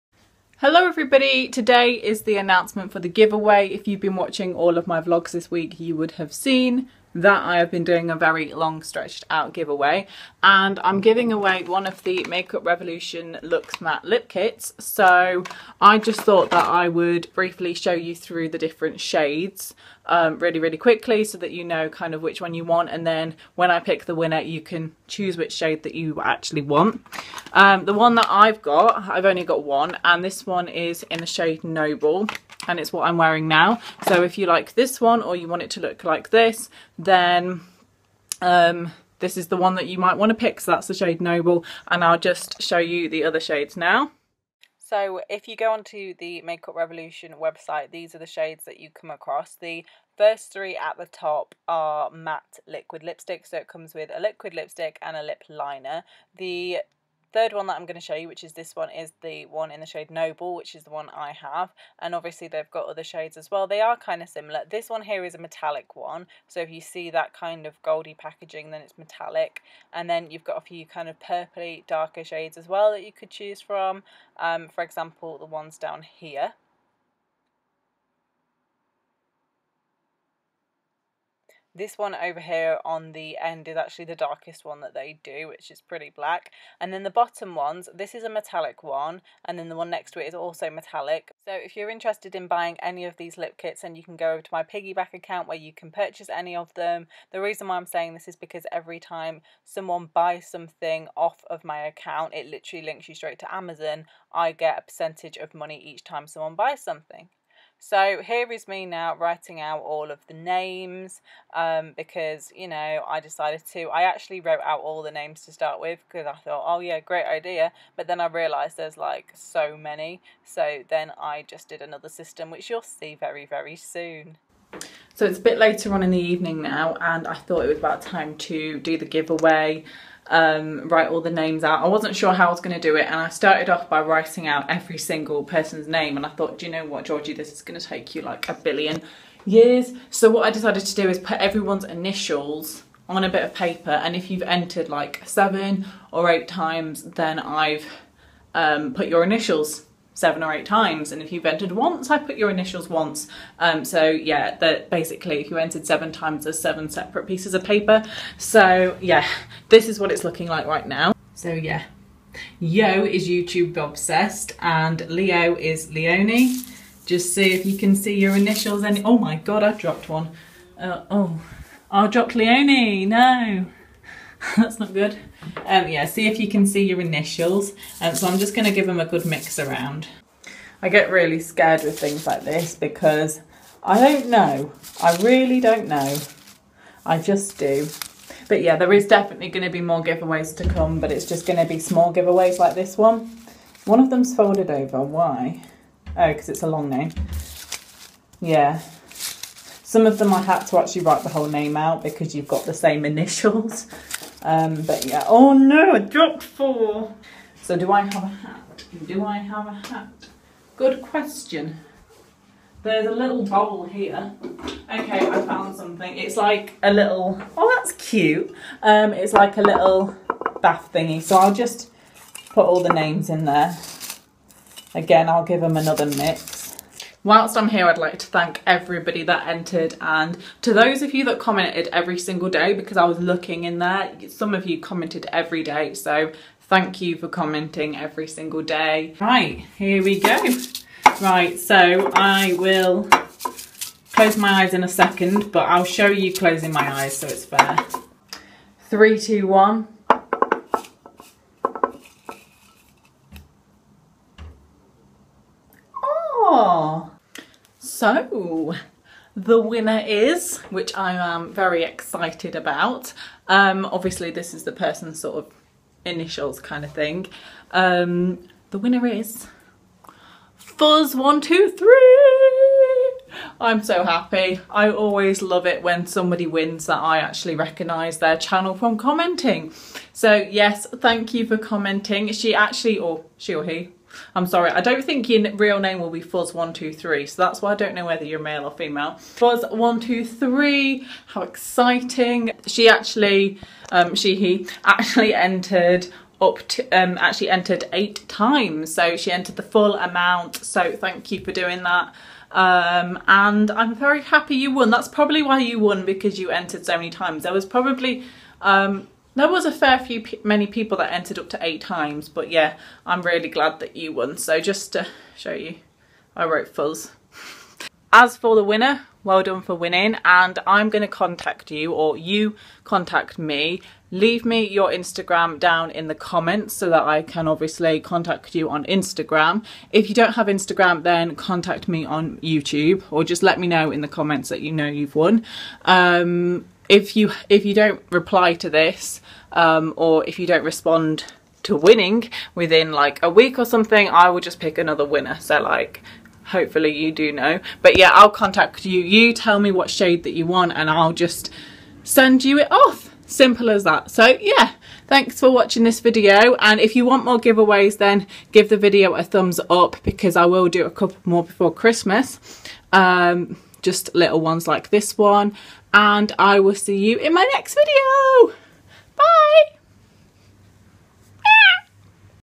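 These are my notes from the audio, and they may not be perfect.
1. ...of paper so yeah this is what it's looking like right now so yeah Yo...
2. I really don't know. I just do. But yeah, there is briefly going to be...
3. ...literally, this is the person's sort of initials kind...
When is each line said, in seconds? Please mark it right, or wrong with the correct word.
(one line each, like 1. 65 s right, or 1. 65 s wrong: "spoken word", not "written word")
1. 157 s right
2. 185 s wrong: "definitely", not "briefly"
3. 263 s wrong: "obviously", not "literally".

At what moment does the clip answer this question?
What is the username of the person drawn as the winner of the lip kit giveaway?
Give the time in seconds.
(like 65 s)
270 s.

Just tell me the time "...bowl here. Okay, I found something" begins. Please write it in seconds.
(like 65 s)
213 s.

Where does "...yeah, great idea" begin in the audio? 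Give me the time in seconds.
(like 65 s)
116 s.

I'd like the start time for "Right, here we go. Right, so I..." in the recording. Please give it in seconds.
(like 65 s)
239 s.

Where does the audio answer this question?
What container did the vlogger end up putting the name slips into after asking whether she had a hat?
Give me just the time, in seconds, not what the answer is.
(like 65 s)
219 s.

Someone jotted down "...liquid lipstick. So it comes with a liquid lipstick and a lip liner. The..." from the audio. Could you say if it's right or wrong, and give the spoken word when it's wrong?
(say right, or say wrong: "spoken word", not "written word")
right.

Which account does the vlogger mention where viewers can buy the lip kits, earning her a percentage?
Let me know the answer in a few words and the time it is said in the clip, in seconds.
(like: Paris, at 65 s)
piggeeback, at 94 s.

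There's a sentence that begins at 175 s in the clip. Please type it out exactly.
Um, yeah, see if you can see your initials.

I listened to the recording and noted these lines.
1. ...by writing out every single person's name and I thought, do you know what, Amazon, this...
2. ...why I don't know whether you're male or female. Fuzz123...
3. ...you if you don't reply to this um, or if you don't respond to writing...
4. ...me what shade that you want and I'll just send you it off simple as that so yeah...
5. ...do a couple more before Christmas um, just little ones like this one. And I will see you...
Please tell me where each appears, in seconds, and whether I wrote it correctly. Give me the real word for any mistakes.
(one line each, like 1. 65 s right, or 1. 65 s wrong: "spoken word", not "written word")
1. 133 s wrong: "Georgie", not "Amazon"
2. 287 s right
3. 337 s wrong: "winning", not "writing"
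4. 349 s right
5. 360 s right.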